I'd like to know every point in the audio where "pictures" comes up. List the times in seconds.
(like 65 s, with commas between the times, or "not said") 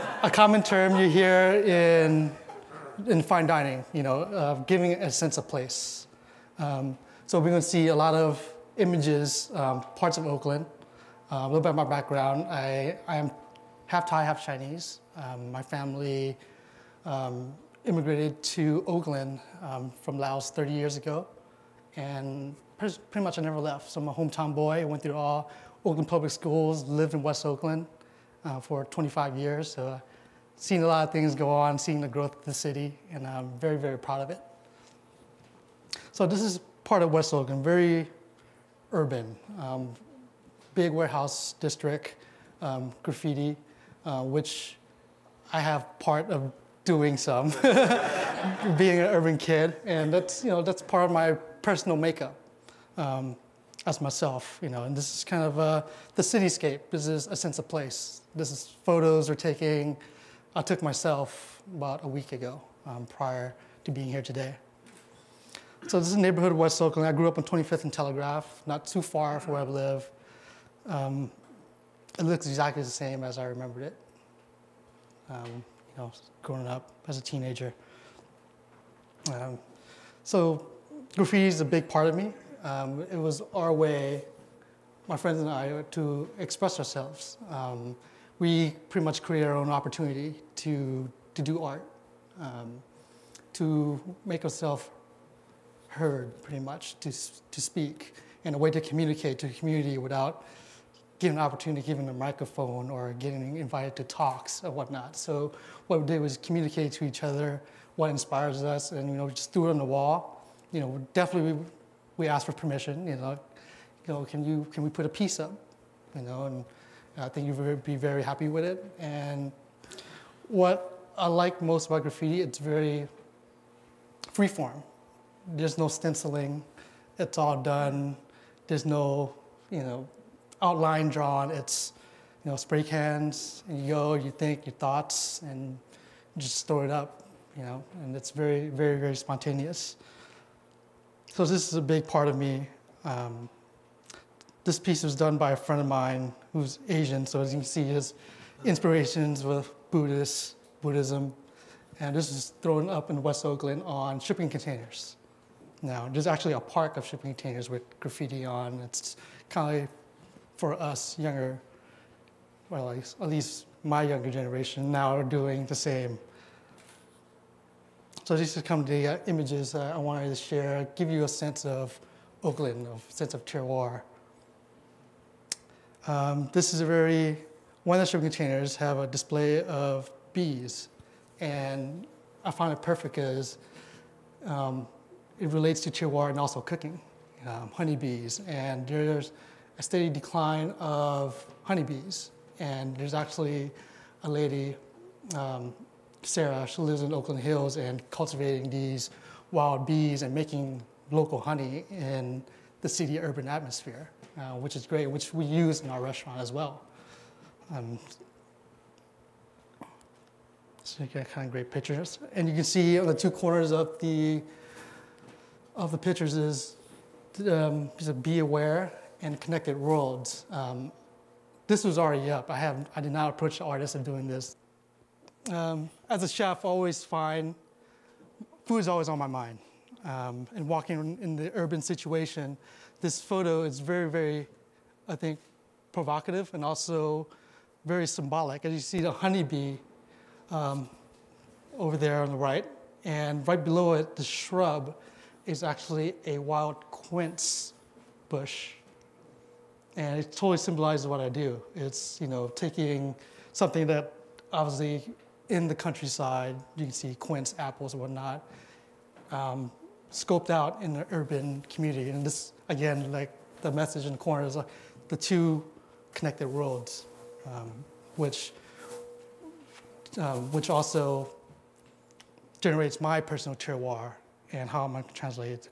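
211 s, 215 s.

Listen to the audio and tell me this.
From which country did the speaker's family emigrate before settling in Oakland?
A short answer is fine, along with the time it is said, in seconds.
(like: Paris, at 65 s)
Laos, at 20 s.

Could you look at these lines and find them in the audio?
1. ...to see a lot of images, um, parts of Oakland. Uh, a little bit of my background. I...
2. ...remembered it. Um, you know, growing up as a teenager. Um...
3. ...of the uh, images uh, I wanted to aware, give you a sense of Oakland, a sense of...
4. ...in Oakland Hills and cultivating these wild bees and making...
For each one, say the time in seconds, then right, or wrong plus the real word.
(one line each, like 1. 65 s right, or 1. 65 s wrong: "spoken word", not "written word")
1. 7 s right
2. 73 s right
3. 168 s wrong: "share", not "aware"
4. 197 s right.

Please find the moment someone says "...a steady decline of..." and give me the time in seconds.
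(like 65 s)
189 s.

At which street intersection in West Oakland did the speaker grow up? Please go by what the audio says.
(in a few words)
25th and Telegraph.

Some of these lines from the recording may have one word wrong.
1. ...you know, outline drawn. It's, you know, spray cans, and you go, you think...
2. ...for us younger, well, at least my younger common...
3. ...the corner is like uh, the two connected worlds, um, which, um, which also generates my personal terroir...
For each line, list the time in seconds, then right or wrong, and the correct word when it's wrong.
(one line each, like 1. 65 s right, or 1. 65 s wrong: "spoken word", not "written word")
1. 129 s right
2. 160 s wrong: "generation", not "common"
3. 264 s right.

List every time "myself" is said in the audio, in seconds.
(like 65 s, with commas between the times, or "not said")
54 s, 60 s.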